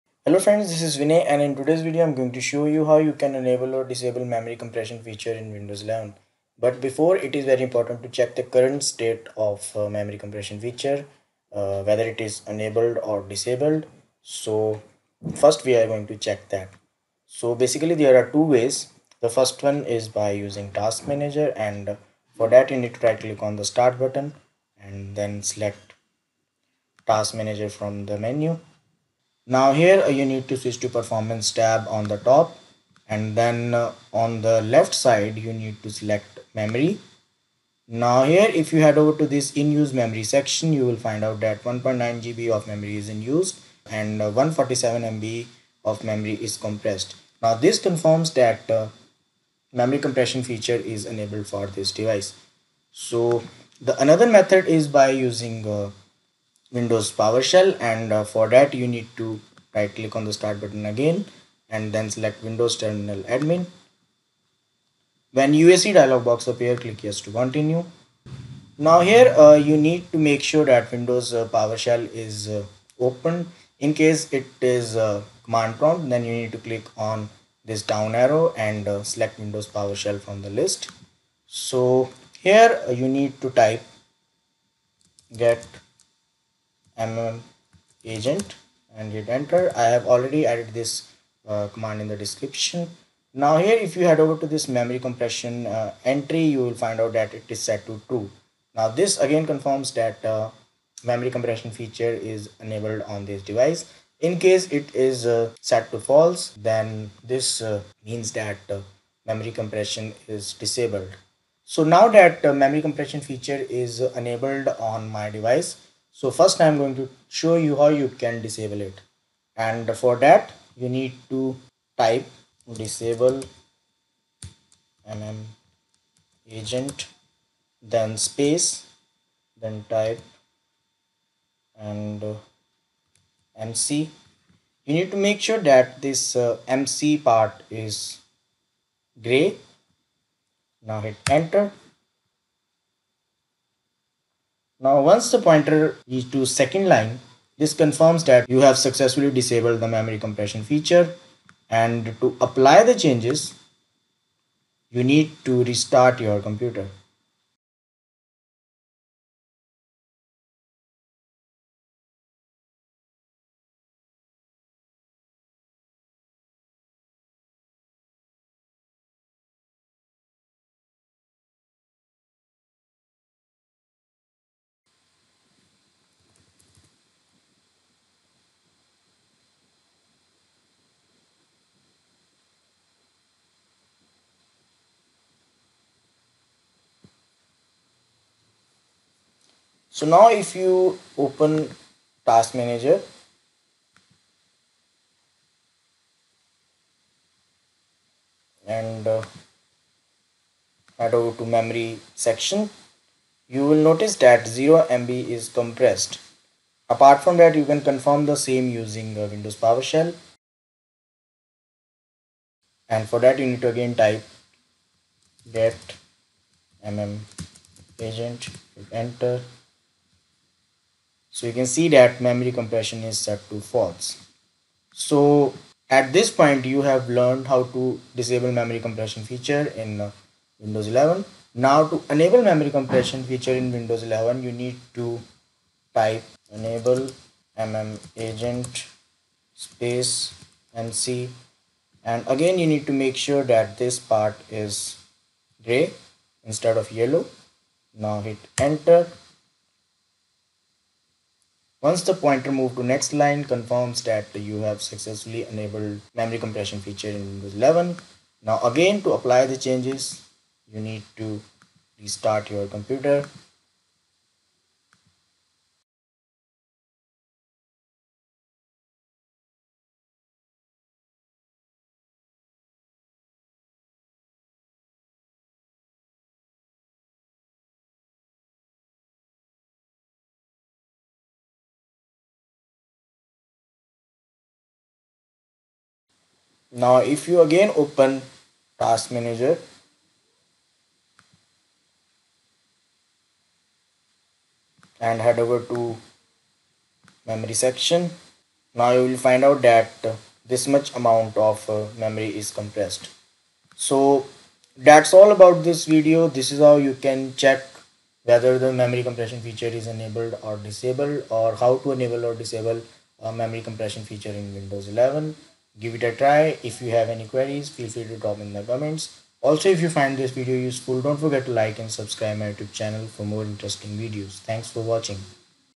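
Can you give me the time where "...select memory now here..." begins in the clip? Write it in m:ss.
0:35.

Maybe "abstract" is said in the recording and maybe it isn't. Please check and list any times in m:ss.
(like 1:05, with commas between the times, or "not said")
not said.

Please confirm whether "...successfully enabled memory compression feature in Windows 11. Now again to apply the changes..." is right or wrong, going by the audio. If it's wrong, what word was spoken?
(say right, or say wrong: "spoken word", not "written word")
right.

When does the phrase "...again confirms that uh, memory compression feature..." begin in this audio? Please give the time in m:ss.
1:39.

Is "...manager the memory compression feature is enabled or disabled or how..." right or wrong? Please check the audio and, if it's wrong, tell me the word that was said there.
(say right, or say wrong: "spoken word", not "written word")
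wrong: "whether", not "manager".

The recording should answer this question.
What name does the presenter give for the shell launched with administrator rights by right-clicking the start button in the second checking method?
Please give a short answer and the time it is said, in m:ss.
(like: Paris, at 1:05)
Windows Terminal Admin, at 1:02.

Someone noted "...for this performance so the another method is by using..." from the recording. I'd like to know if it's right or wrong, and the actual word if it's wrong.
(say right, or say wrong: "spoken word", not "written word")
wrong: "device", not "performance".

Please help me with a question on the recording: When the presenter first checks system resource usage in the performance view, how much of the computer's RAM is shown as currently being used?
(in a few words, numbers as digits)
1.9 GB.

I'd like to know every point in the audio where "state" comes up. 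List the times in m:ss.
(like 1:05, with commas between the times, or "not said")
0:08.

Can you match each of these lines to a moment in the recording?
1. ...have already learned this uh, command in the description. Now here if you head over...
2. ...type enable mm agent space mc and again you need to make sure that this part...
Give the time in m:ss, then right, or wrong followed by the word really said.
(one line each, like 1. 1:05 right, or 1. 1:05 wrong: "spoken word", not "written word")
1. 1:29 wrong: "added", not "learned"
2. 3:55 right.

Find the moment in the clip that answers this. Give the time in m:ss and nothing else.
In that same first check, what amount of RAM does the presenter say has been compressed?
0:44.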